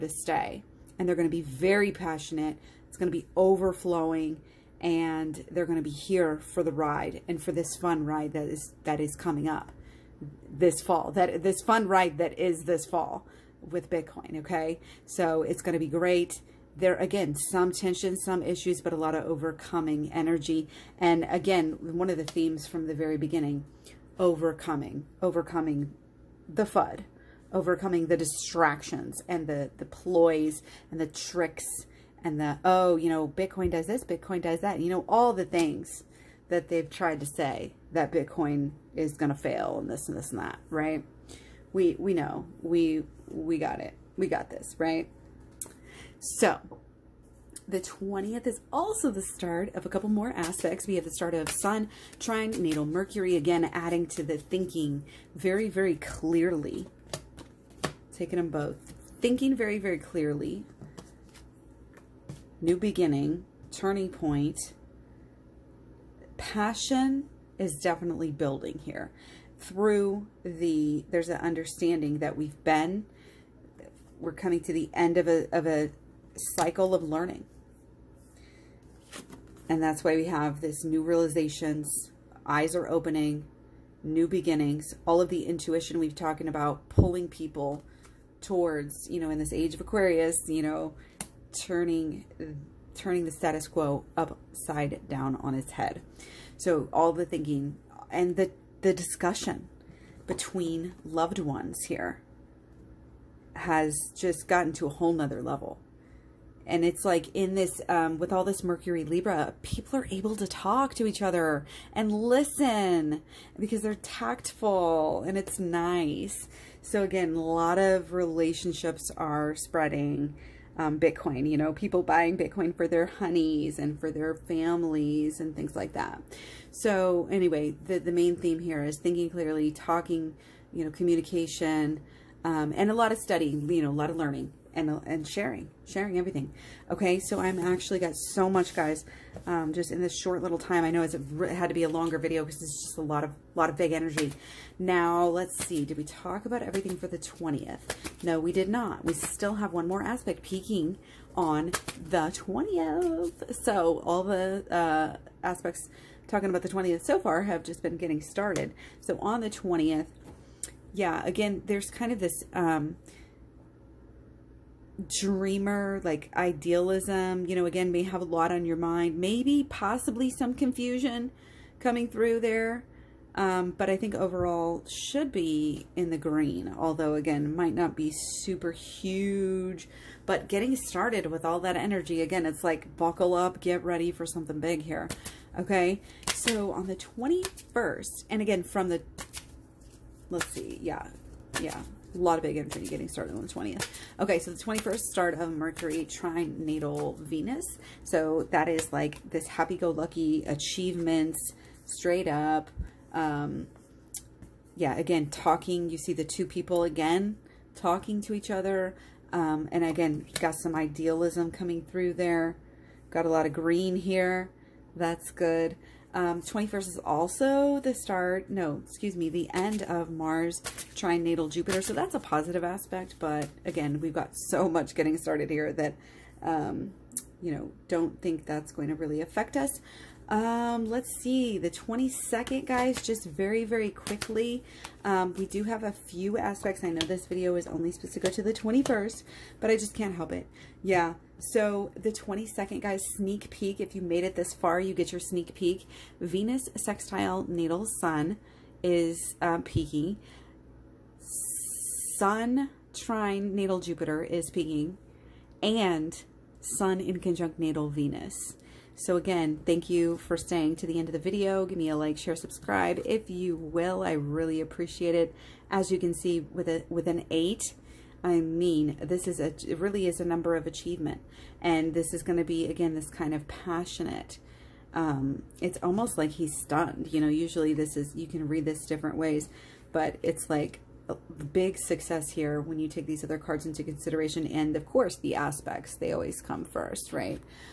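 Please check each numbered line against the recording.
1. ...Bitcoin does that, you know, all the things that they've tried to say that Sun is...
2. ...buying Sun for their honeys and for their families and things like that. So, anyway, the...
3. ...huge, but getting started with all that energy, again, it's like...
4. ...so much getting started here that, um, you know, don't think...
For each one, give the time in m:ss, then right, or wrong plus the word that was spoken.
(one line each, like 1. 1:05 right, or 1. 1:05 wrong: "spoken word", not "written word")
1. 0:34 wrong: "Bitcoin", not "Sun"
2. 2:02 wrong: "Bitcoin", not "Sun"
3. 2:58 right
4. 3:44 right.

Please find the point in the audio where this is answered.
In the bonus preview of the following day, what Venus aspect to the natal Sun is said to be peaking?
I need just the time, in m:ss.
4:06.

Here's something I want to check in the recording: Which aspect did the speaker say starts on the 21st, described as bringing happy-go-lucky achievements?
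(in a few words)
Mercury trine natal Venus.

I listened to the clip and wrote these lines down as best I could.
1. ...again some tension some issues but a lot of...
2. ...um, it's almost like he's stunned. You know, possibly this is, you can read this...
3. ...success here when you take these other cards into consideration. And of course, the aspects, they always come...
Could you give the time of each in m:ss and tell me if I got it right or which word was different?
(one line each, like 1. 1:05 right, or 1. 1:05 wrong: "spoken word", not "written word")
1. 0:16 right
2. 4:34 wrong: "usually", not "possibly"
3. 4:41 right.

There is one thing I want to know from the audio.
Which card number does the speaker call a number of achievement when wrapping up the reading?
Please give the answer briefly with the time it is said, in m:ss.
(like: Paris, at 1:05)
8, at 4:27.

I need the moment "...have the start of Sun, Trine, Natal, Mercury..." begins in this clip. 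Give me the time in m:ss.
0:50.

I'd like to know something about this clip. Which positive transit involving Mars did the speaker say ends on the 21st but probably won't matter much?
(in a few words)
Mars trine natal Jupiter.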